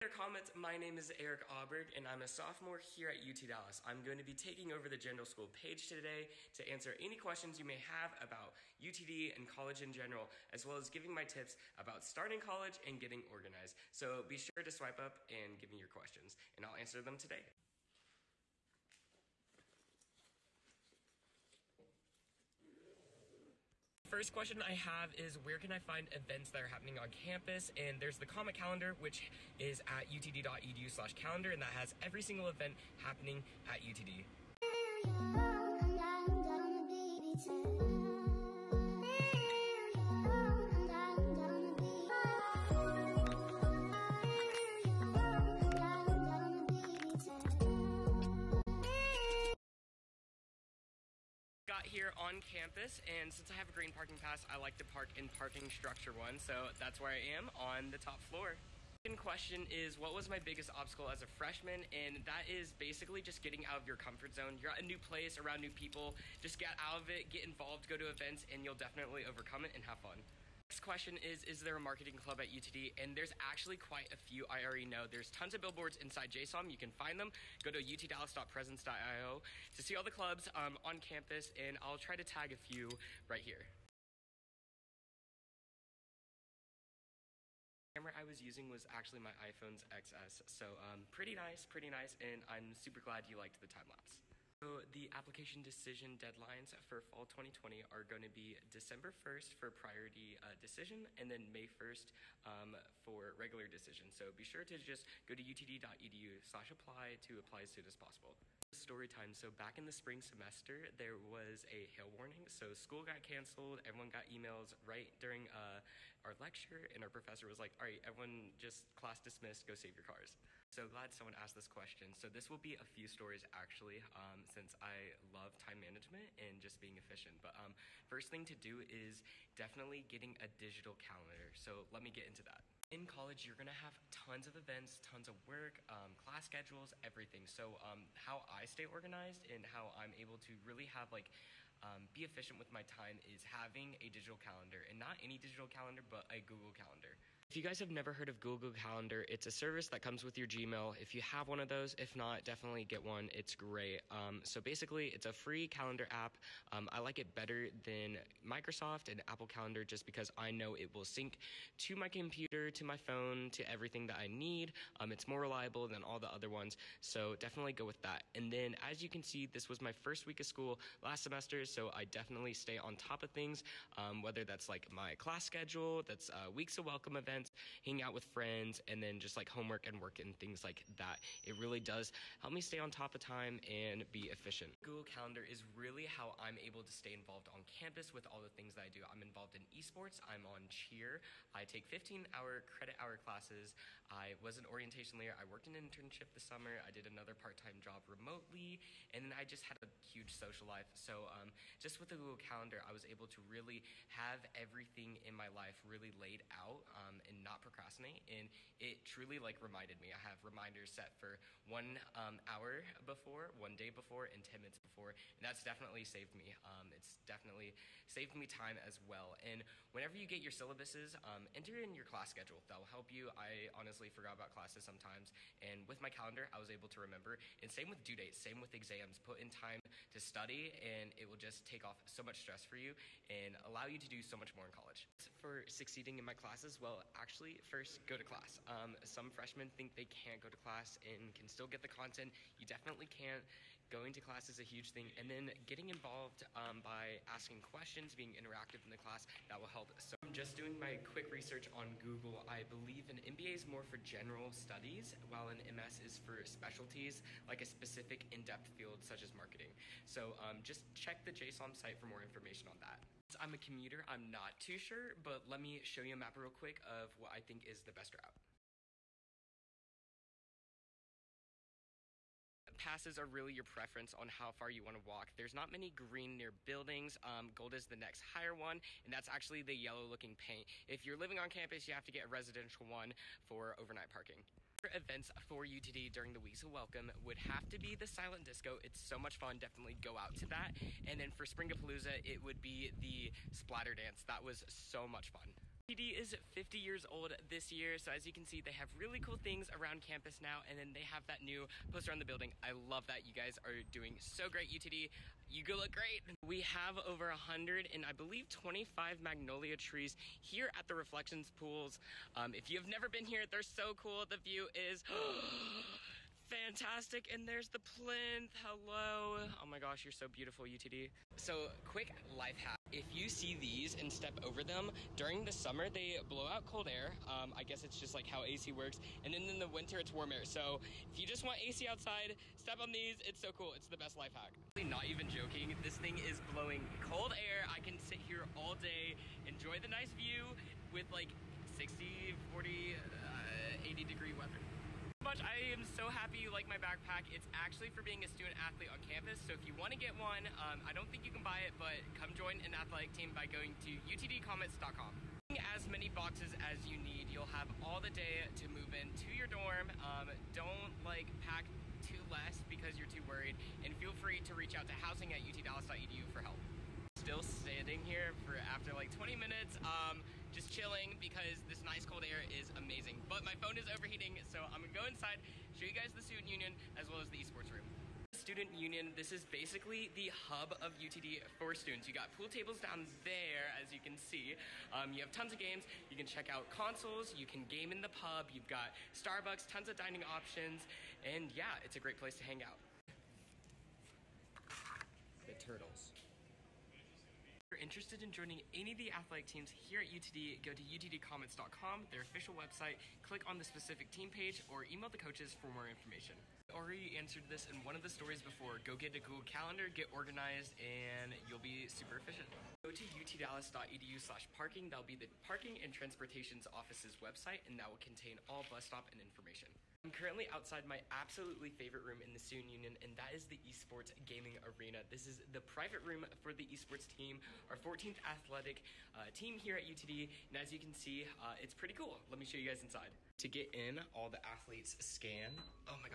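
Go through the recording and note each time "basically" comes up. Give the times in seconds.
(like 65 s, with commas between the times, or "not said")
62 s, 154 s, 379 s.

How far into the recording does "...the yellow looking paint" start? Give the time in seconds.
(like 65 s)
279 s.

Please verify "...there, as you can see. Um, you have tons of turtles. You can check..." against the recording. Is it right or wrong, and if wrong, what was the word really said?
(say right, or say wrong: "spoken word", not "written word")
wrong: "games", not "turtles".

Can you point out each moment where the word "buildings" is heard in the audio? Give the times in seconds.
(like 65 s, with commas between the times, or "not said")
276 s, 302 s.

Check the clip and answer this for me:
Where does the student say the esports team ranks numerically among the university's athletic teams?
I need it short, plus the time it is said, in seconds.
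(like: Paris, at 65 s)
14th, at 427 s.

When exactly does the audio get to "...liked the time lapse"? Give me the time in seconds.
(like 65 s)
93 s.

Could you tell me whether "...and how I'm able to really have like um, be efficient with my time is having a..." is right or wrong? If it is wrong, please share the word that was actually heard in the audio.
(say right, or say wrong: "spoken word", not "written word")
right.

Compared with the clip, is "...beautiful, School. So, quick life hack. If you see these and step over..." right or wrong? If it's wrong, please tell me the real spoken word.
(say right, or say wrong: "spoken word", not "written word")
wrong: "UTD", not "School".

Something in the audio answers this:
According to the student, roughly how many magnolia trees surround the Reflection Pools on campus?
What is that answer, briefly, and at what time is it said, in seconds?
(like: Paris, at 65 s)
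125, at 307 s.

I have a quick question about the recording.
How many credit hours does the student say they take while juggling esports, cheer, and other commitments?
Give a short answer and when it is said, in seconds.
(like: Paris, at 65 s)
15, at 191 s.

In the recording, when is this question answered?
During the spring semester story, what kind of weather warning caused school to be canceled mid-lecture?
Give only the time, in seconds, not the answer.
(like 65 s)
111 s.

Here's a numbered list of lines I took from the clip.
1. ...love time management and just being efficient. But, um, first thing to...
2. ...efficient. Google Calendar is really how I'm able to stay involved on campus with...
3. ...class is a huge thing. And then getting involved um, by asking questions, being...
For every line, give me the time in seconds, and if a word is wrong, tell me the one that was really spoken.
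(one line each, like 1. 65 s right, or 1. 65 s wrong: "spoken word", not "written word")
1. 125 s right
2. 184 s right
3. 244 s right.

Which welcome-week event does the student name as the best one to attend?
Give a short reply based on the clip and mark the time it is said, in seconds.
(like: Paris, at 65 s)
Silent disco, at 288 s.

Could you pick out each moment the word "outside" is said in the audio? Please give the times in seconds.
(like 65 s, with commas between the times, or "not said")
331 s, 420 s.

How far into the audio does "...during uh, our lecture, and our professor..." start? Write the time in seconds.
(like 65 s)
115 s.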